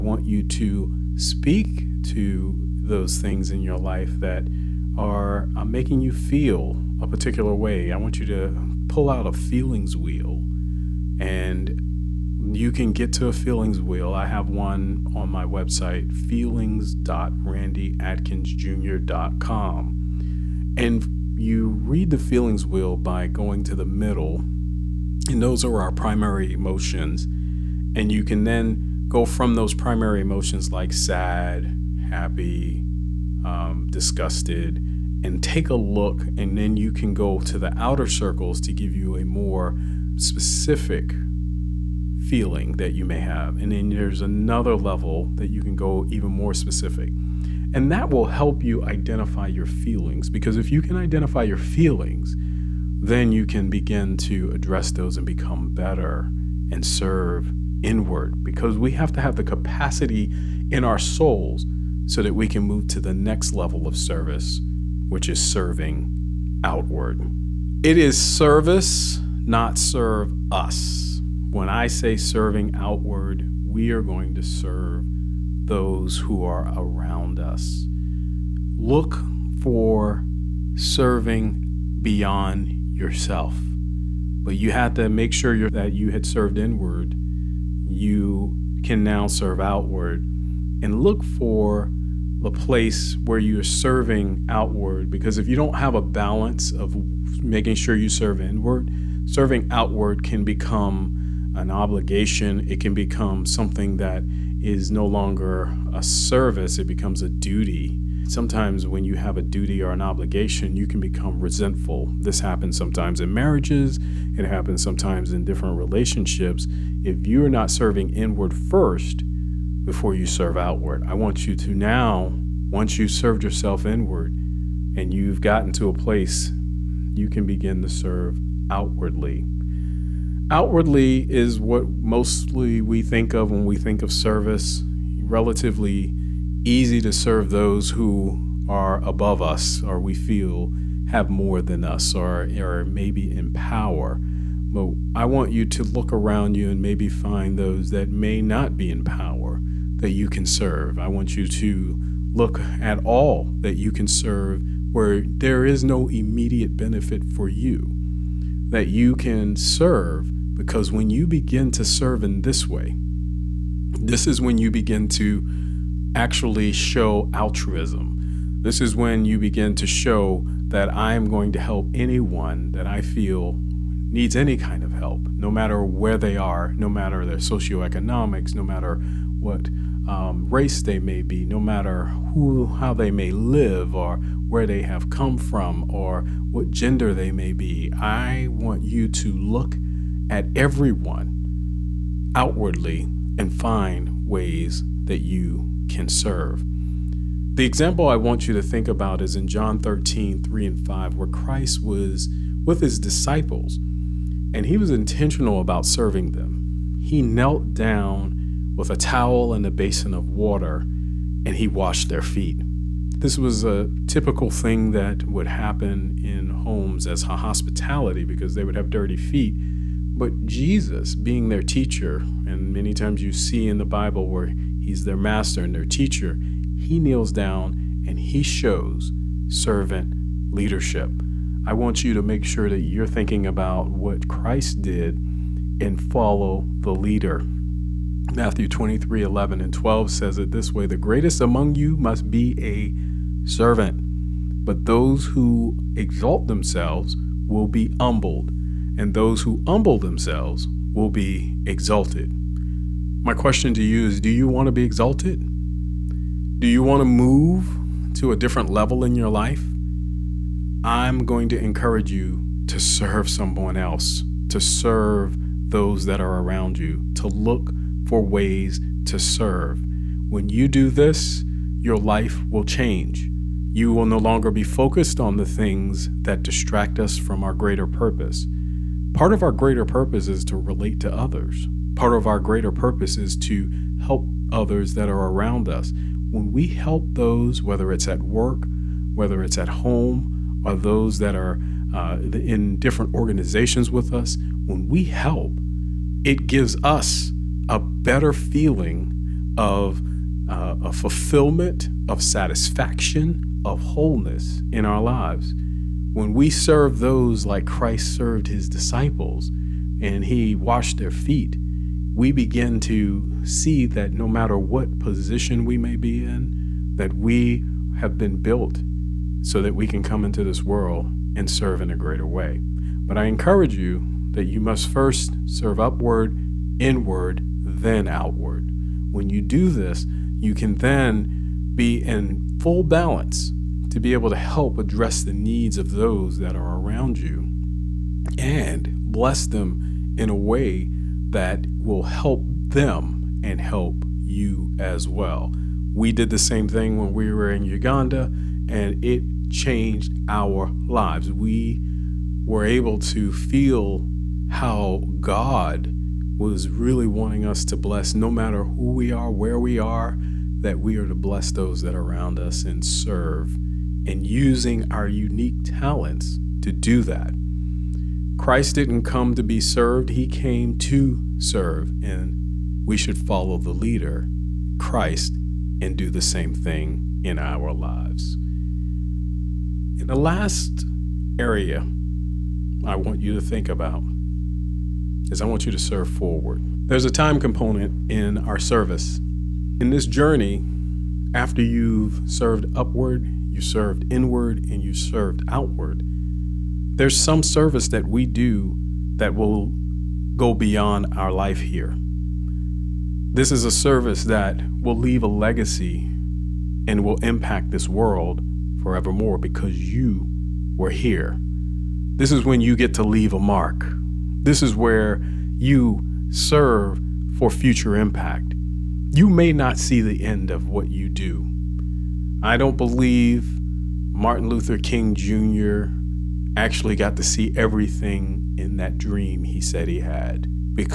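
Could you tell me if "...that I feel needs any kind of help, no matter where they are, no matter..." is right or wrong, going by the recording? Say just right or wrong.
right.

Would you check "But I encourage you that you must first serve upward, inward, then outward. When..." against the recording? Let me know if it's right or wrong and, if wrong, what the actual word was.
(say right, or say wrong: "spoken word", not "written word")
right.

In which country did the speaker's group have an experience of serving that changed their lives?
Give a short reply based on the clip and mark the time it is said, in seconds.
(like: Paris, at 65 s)
Uganda, at 347 s.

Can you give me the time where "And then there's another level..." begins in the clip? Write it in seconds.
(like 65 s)
43 s.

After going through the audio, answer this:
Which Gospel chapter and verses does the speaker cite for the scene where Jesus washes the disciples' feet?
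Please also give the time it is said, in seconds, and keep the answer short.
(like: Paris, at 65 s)
John 13, 3 and 5, at 199 s.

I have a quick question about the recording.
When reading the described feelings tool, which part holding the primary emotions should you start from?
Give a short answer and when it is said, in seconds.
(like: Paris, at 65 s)
the middle, at 23 s.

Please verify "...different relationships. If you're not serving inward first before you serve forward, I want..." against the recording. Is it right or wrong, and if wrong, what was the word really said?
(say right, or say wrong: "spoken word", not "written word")
wrong: "outward", not "forward".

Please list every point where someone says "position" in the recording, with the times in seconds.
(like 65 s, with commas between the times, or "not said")
314 s.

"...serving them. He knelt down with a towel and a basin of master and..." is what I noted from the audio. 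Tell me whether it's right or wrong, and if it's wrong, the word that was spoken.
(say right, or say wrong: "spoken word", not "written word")
wrong: "water", not "master".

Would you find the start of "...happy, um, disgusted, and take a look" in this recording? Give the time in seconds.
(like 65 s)
32 s.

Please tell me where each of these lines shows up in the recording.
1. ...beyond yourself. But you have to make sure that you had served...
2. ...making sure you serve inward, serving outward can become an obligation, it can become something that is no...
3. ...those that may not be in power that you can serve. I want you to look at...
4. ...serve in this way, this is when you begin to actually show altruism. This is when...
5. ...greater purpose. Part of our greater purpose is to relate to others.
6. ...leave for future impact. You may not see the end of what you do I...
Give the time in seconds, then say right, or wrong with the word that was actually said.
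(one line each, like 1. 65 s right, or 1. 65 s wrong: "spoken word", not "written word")
1. 82 s right
2. 97 s right
3. 147 s right
4. 161 s right
5. 277 s right
6. 416 s wrong: "serve", not "leave".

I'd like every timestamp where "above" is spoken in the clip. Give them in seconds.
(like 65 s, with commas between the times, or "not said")
139 s.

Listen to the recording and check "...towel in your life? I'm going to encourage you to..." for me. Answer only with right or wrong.
wrong.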